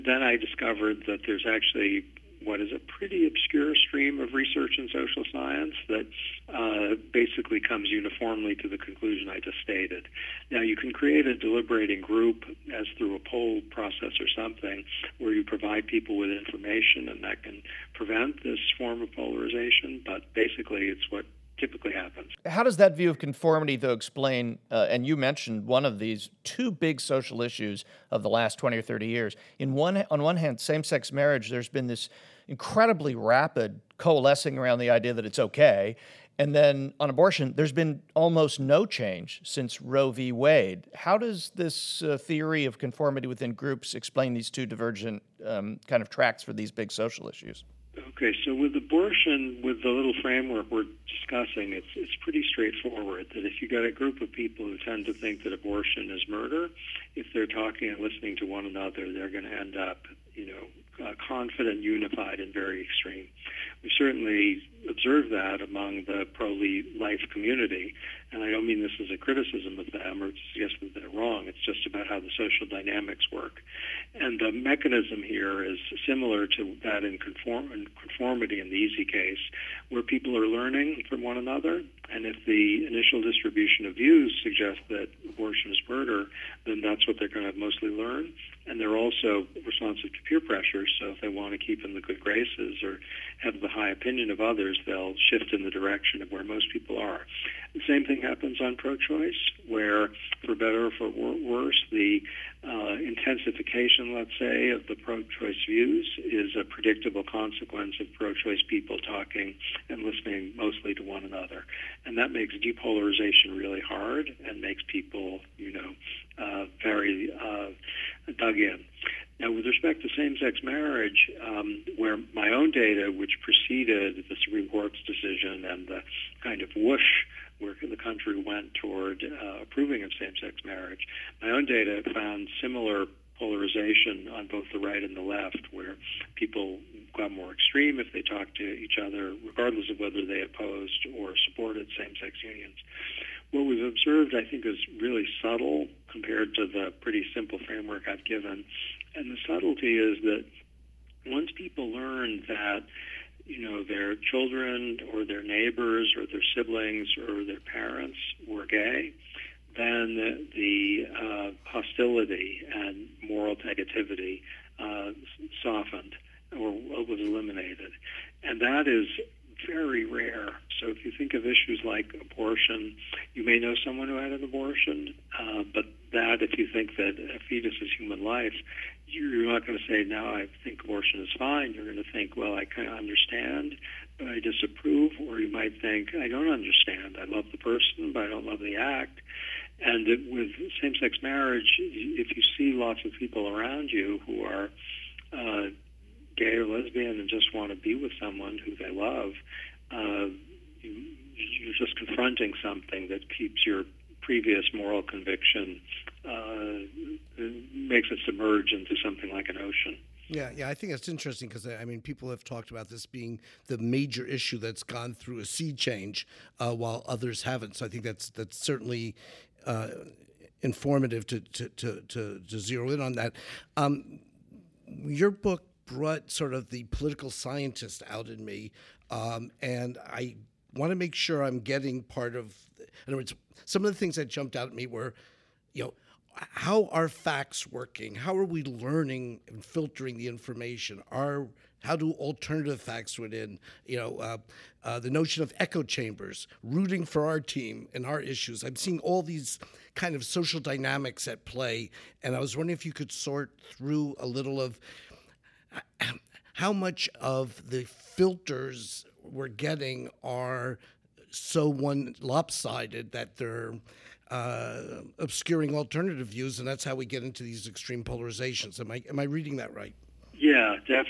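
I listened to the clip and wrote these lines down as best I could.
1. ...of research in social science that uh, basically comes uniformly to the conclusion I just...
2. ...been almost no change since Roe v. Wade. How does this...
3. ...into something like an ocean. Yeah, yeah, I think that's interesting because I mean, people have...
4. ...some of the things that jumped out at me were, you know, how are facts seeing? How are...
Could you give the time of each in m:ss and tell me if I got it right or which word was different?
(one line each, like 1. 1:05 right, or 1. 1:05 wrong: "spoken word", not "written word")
1. 0:04 right
2. 0:37 right
3. 3:28 right
4. 3:53 wrong: "working", not "seeing".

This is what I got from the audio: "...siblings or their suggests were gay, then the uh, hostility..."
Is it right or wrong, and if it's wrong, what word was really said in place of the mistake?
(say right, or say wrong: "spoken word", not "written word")
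wrong: "parents", not "suggests".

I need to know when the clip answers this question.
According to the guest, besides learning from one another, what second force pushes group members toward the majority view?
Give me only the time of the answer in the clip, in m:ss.
1:30.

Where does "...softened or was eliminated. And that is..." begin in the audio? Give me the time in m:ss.
2:45.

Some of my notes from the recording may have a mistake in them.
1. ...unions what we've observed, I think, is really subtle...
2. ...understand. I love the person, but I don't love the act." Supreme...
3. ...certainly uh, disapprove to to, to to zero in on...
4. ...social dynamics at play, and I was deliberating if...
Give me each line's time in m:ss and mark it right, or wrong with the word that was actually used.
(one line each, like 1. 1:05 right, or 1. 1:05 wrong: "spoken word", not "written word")
1. 2:22 right
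2. 3:06 wrong: "And", not "Supreme"
3. 3:38 wrong: "informative", not "disapprove"
4. 4:10 wrong: "wondering", not "deliberating".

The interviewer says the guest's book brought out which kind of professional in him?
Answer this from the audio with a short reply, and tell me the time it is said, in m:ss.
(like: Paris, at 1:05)
Political scientist, at 3:46.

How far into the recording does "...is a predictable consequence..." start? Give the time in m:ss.
1:46.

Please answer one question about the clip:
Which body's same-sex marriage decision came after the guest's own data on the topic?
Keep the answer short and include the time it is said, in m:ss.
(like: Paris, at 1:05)
The Supreme Court, at 2:04.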